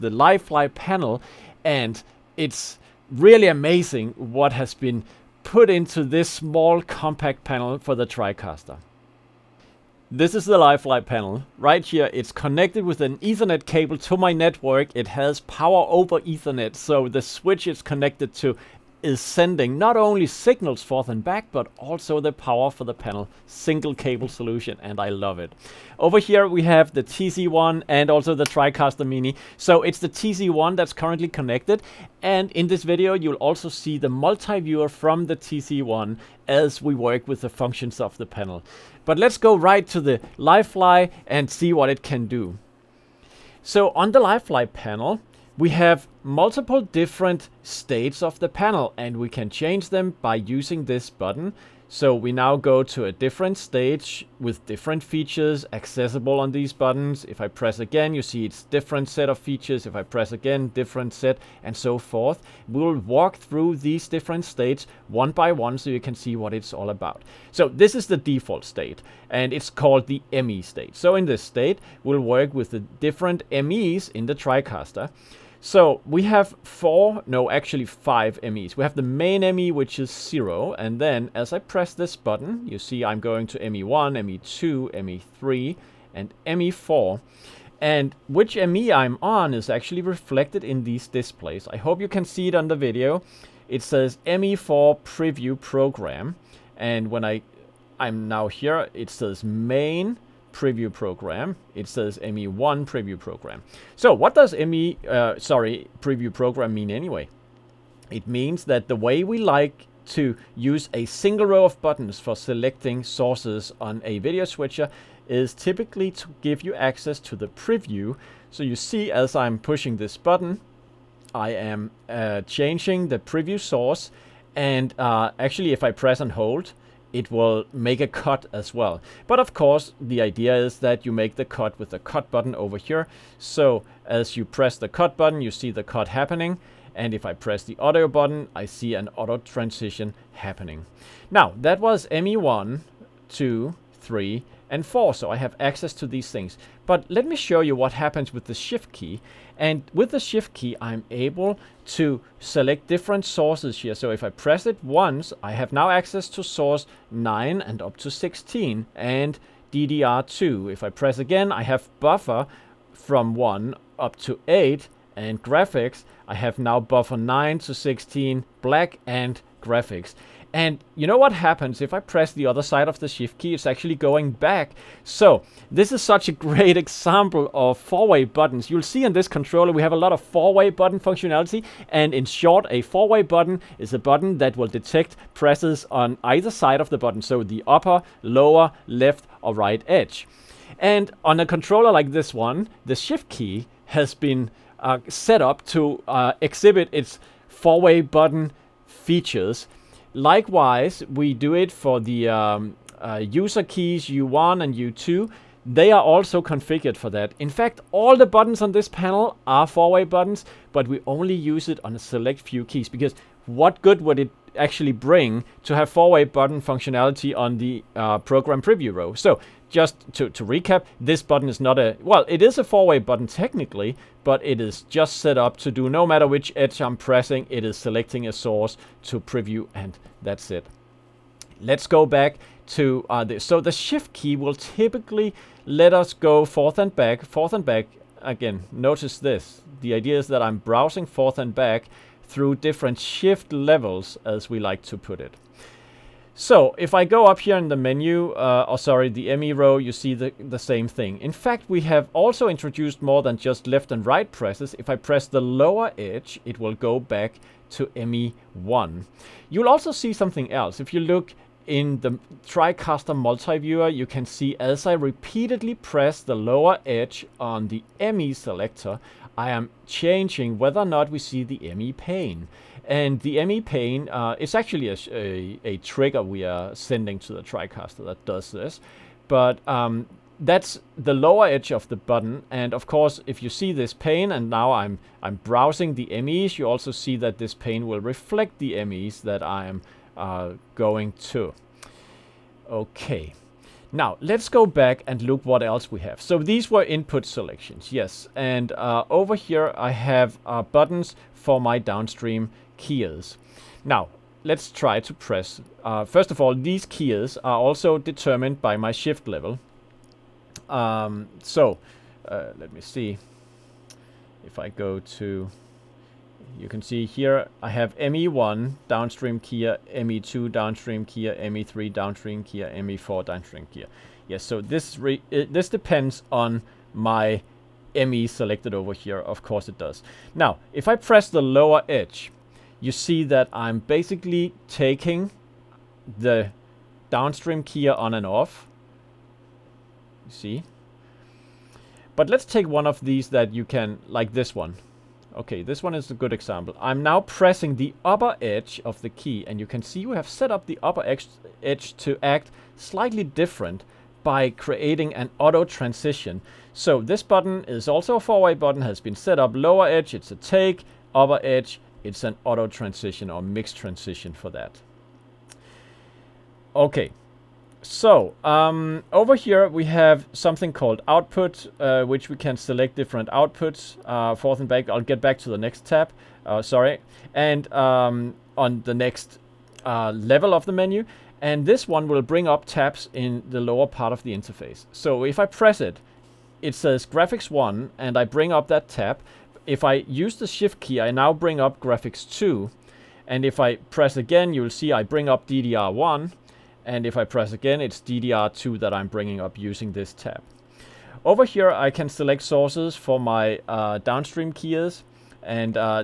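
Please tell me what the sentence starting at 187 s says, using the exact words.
So the upper, lower, left or right edge.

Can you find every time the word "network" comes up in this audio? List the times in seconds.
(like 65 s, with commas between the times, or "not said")
14 s.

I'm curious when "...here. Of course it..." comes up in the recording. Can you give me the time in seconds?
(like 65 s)
328 s.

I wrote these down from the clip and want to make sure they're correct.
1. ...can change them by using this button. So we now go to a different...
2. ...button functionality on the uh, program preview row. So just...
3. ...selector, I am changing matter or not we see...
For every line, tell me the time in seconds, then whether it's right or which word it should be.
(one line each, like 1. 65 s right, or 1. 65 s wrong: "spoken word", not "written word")
1. 49 s right
2. 216 s right
3. 268 s wrong: "whether", not "matter".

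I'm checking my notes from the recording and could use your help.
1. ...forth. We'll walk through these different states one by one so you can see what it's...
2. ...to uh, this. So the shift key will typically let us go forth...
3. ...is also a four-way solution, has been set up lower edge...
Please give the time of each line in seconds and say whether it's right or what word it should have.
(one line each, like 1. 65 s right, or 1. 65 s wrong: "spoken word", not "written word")
1. 61 s right
2. 232 s right
3. 357 s wrong: "button", not "solution".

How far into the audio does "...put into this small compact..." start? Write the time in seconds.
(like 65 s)
5 s.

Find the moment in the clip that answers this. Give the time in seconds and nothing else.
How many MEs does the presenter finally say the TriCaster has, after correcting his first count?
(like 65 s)
77 s.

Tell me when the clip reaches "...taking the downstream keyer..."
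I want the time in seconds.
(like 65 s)
334 s.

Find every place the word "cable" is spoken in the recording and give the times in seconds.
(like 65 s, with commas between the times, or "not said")
13 s, 23 s.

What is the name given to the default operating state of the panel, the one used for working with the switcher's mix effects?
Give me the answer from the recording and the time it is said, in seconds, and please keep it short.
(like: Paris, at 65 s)
ME state, at 70 s.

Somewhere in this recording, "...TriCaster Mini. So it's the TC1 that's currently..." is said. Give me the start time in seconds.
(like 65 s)
28 s.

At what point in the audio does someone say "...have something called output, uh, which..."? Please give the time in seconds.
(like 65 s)
369 s.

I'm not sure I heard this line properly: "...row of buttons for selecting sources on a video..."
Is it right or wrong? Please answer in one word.
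right.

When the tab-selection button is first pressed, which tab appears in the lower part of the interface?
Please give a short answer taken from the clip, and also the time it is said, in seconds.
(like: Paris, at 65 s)
Graphics 1, at 387 s.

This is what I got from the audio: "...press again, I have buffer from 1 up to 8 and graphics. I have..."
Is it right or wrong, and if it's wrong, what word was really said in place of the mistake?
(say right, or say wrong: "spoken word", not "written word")
right.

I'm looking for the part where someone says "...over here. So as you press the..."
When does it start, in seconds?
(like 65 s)
132 s.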